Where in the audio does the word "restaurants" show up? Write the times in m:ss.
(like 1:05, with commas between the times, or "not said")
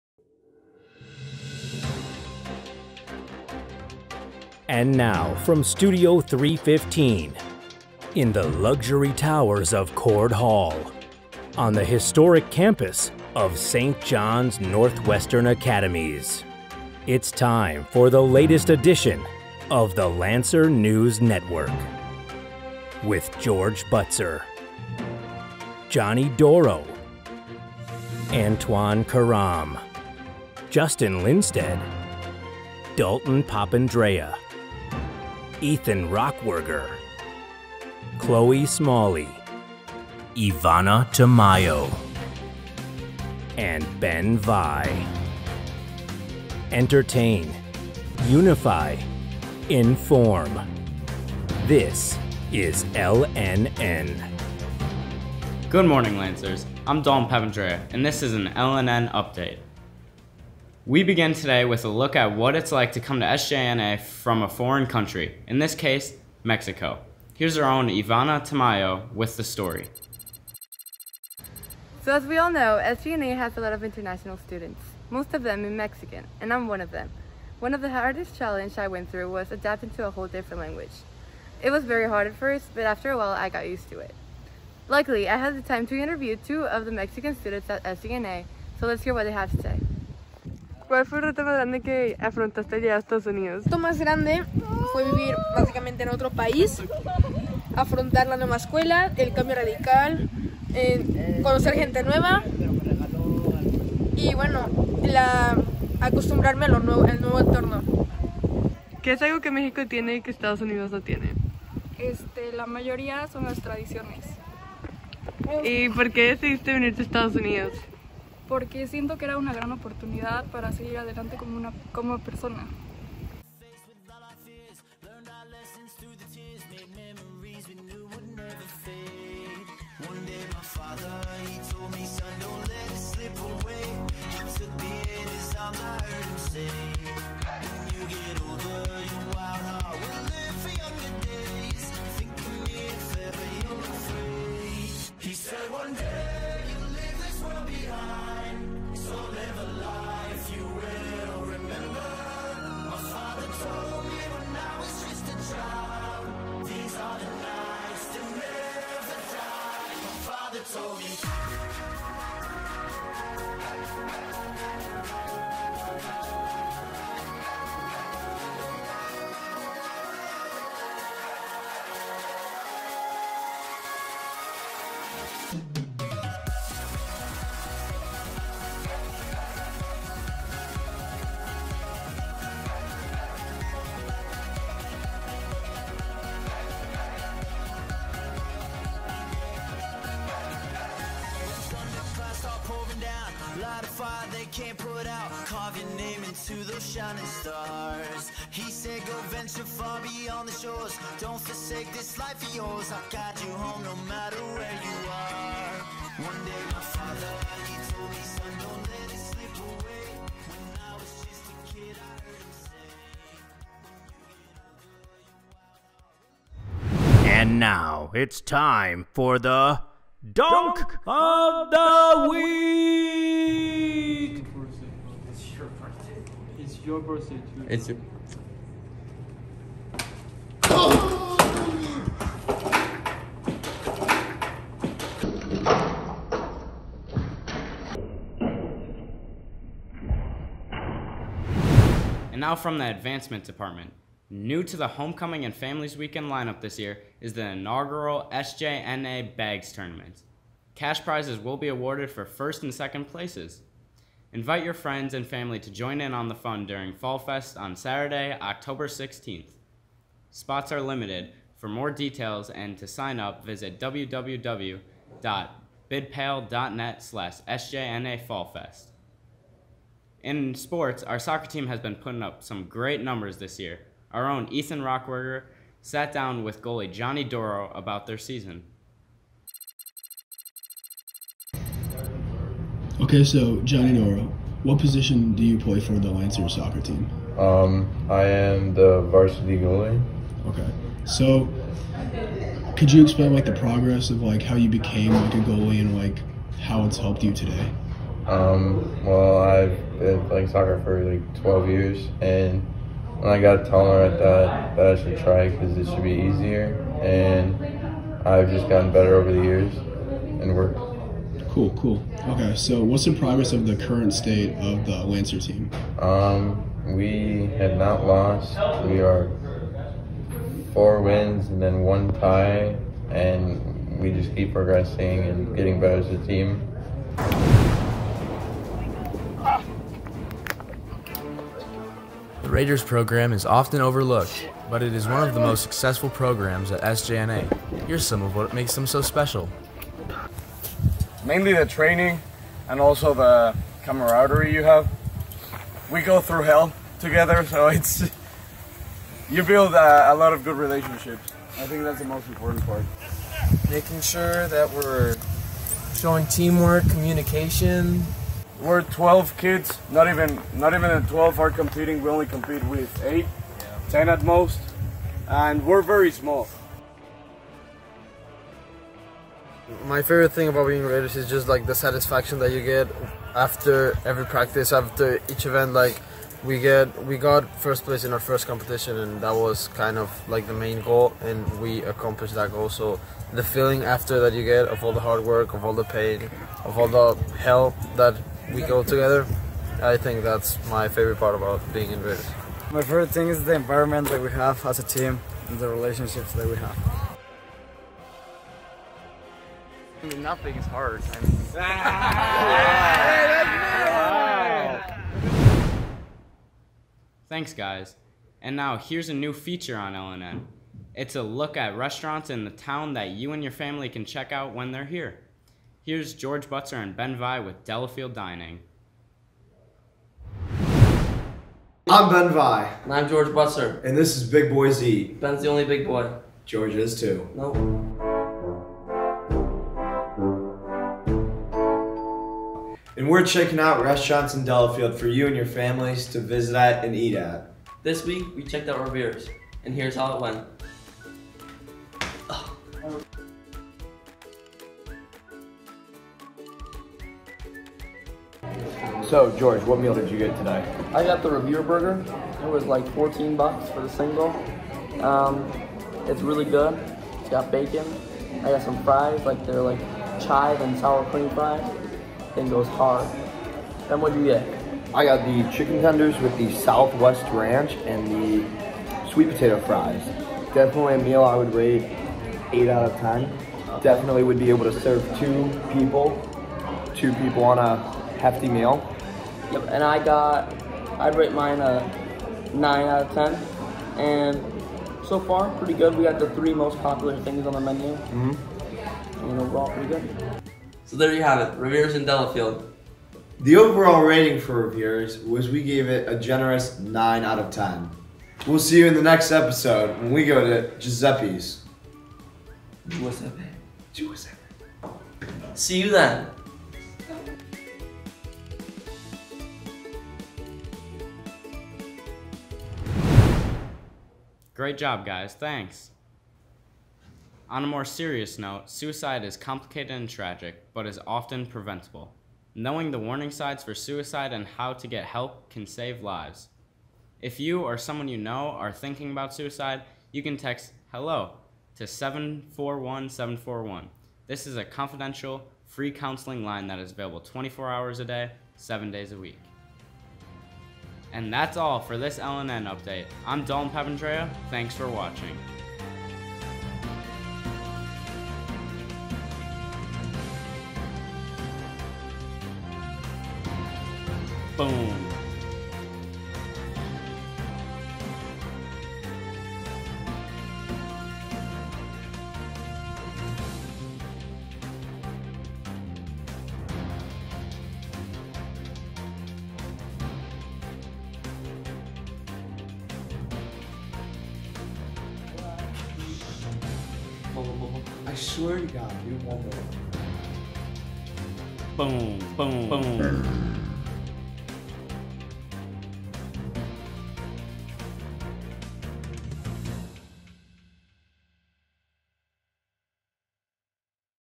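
6:51, 7:13.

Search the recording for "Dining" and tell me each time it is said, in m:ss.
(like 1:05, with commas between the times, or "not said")
6:58.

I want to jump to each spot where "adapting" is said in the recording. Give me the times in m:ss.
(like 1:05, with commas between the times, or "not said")
1:19.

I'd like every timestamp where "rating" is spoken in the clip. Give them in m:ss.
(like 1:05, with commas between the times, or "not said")
8:14.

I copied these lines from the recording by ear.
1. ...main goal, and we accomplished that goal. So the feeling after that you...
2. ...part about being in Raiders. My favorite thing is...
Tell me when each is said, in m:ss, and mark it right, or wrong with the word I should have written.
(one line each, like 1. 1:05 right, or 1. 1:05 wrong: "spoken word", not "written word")
1. 6:20 right
2. 6:31 right.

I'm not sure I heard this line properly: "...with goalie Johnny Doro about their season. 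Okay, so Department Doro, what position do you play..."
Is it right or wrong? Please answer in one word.
wrong.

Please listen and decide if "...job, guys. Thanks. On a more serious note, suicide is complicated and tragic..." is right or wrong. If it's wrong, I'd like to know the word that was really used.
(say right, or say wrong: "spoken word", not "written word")
right.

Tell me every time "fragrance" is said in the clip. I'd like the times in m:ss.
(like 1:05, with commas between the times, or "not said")
not said.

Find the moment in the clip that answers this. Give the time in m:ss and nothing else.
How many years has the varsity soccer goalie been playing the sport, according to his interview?
5:01.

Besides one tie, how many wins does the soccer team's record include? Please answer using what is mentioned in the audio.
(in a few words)
4 wins.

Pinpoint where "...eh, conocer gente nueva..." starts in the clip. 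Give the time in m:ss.
1:40.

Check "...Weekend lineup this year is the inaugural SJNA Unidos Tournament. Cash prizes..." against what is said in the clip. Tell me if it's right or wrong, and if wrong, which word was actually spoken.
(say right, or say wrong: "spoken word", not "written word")
wrong: "Bags", not "Unidos".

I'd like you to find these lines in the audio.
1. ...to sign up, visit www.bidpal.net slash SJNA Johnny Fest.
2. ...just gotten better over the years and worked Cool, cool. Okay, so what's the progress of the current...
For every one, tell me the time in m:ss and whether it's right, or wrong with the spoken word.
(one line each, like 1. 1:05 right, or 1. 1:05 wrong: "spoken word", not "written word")
1. 4:22 wrong: "Fall", not "Johnny"
2. 5:08 right.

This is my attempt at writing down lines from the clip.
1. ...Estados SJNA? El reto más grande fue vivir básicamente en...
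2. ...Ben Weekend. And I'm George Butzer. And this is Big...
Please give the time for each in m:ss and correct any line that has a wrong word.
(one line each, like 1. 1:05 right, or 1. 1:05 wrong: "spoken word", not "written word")
1. 1:32 wrong: "Unidos", not "SJNA"
2. 7:02 wrong: "Vai", not "Weekend".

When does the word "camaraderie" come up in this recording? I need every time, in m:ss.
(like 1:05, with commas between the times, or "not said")
5:43.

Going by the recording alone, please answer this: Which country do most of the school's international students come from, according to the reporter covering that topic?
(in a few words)
Mexico.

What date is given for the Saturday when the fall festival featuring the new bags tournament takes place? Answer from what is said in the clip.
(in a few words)
October 16th.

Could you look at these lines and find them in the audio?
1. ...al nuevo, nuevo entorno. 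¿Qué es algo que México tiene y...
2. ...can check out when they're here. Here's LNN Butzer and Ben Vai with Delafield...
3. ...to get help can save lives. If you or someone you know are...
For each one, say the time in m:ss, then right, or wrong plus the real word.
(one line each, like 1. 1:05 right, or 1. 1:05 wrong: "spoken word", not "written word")
1. 1:46 right
2. 6:53 wrong: "George", not "LNN"
3. 8:44 right.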